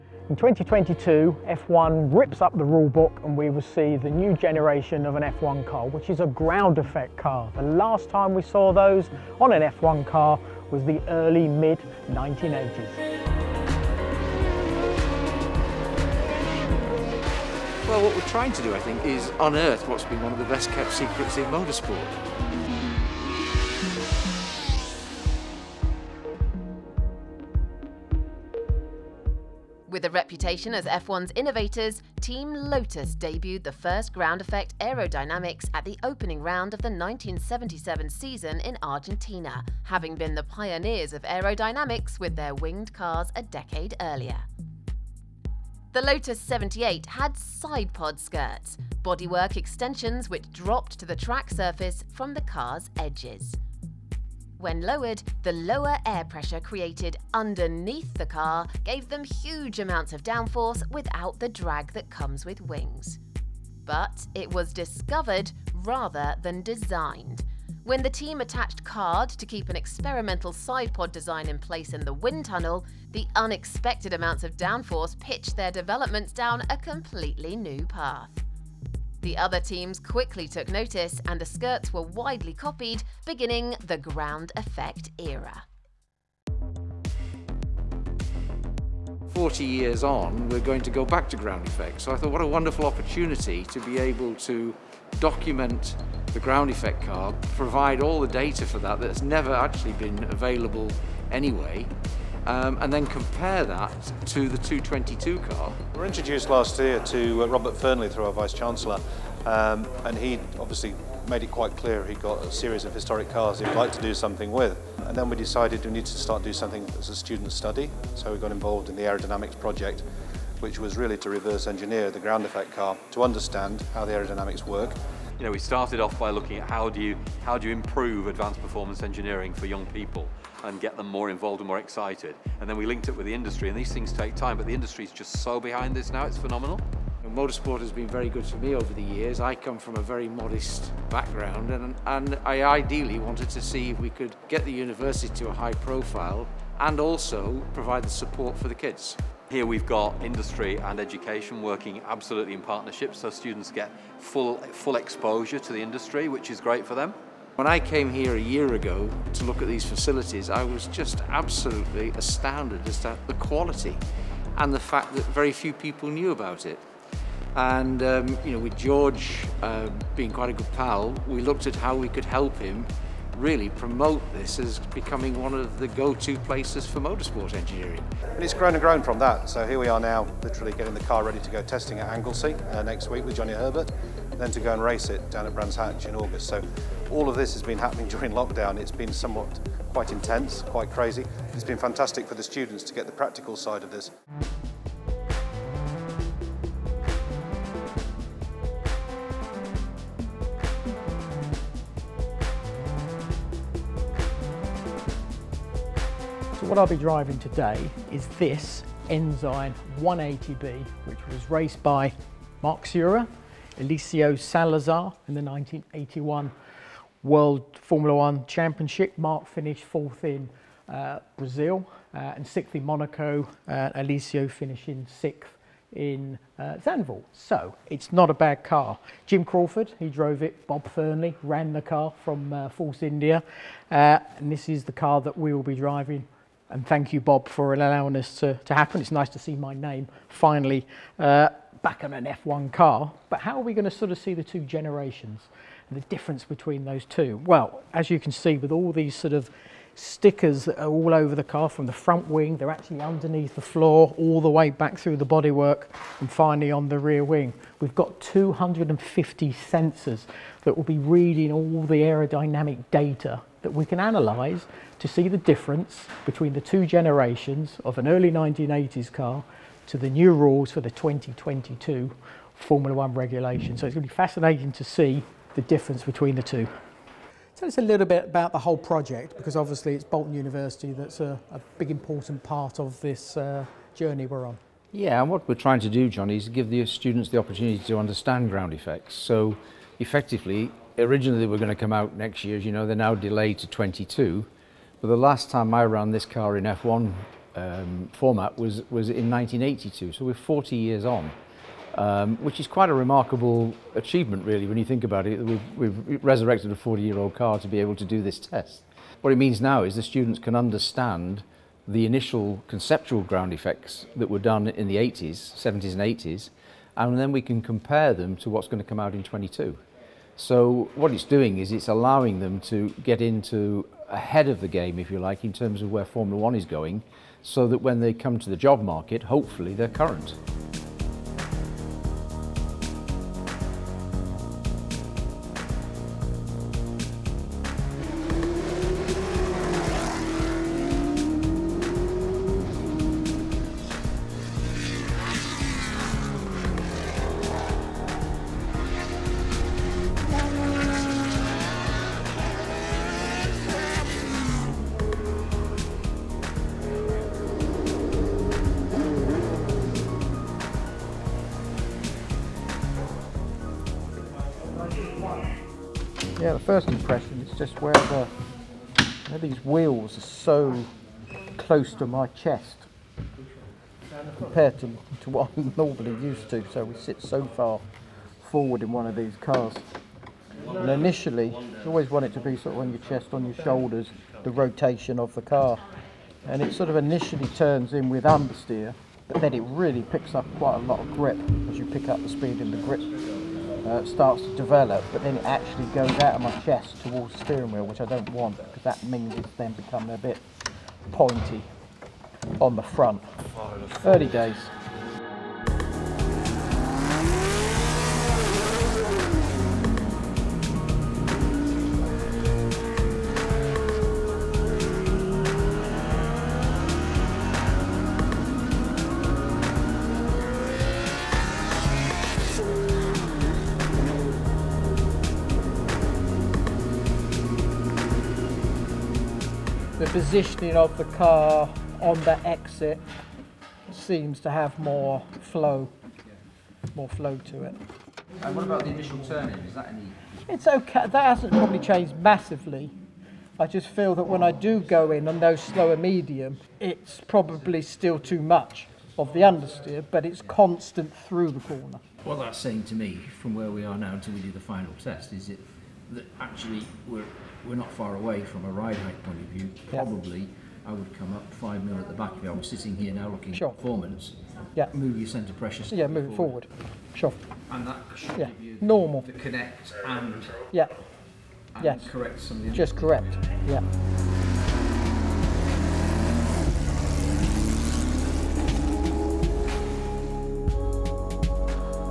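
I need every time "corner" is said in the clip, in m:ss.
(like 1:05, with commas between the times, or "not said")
7:31.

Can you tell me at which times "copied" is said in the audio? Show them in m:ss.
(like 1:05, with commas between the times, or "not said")
1:22.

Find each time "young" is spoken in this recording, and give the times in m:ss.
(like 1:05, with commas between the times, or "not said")
2:09.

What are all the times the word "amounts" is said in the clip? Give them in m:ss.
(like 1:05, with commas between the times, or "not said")
0:59, 1:14.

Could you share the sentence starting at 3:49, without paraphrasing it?
Jim Crawford, who drove it, Bob Fernley ran the car from uh, Force India.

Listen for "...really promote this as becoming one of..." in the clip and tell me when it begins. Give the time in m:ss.
2:53.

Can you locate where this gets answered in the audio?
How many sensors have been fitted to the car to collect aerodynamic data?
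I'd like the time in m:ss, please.
4:18.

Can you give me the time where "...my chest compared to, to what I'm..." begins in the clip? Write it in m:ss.
6:12.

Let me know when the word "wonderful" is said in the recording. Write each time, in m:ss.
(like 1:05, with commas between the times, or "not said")
1:32.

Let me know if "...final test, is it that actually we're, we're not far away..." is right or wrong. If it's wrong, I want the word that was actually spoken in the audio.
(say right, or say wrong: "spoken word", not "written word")
right.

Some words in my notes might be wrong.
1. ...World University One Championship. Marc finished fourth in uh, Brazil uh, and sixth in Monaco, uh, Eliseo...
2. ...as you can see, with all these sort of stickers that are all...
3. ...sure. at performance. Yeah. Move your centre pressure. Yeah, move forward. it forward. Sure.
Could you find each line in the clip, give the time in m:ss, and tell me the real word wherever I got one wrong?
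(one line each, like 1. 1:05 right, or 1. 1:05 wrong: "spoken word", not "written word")
1. 3:37 wrong: "Formula", not "University"
2. 4:07 right
3. 7:43 right.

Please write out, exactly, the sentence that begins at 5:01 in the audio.
Um, which is quite a remarkable achievement, really, when you think about it.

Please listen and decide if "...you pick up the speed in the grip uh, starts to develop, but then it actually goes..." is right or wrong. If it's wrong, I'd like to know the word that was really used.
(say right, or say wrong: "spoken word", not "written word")
right.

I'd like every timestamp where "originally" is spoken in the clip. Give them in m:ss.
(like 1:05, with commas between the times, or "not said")
4:51.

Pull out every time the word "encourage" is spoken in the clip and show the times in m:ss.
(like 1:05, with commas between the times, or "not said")
not said.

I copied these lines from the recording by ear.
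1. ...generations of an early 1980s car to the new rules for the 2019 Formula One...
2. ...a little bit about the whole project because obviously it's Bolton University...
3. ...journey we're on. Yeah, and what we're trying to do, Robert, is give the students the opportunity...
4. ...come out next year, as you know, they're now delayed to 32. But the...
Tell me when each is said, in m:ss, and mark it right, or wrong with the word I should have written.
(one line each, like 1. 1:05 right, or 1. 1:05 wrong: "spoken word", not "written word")
1. 4:26 wrong: "2022", not "2019"
2. 4:37 right
3. 4:43 wrong: "Johnny", not "Robert"
4. 4:51 wrong: "22", not "32".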